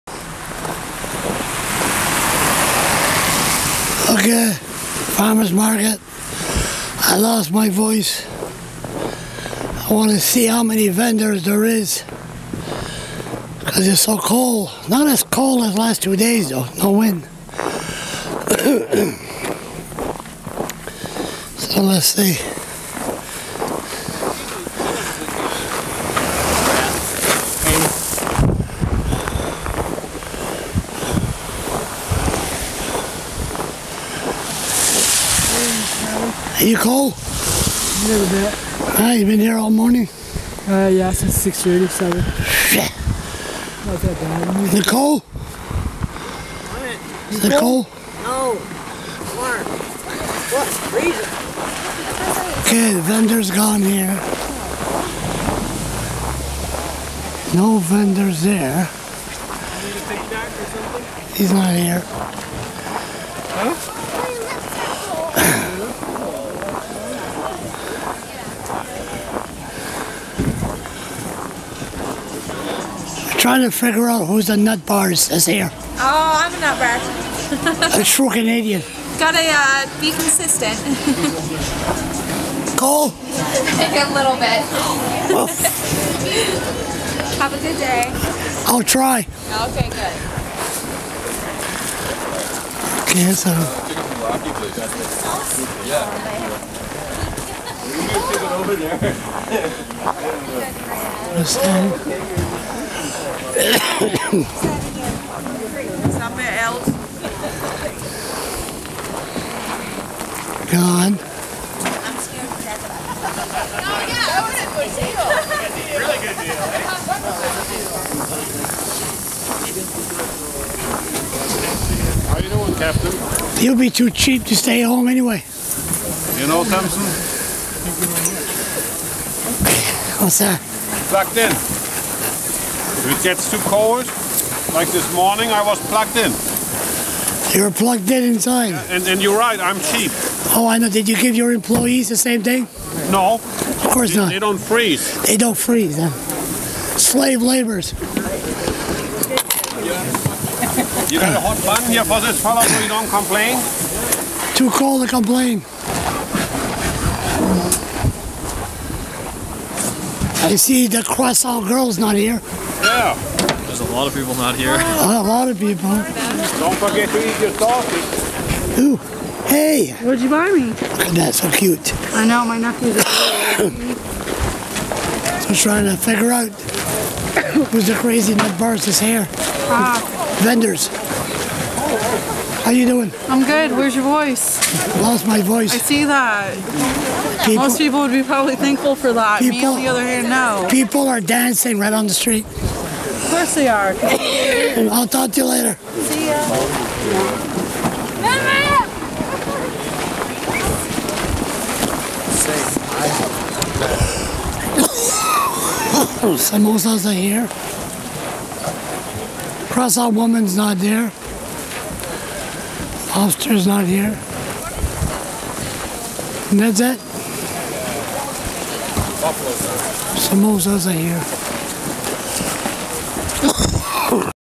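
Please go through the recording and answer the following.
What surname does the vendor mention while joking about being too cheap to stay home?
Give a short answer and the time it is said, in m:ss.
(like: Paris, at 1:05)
Thompson, at 2:06.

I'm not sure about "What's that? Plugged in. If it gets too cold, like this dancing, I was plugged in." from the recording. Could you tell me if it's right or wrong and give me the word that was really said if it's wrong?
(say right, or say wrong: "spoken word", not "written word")
wrong: "morning", not "dancing".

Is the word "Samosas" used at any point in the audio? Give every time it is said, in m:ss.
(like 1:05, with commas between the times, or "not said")
3:26, 3:40.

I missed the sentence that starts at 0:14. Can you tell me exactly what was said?
Not as cold as last two days though, no wind.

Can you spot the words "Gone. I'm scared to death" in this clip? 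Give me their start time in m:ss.
1:50.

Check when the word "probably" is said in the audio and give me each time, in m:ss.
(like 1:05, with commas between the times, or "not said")
3:08.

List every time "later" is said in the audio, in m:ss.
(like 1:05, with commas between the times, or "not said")
3:15.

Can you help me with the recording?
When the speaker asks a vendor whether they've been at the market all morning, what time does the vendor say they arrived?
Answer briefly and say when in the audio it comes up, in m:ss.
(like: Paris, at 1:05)
6:30, at 0:41.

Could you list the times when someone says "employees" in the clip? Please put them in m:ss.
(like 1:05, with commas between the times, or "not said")
2:21.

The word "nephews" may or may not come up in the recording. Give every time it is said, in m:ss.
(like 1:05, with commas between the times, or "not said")
2:52.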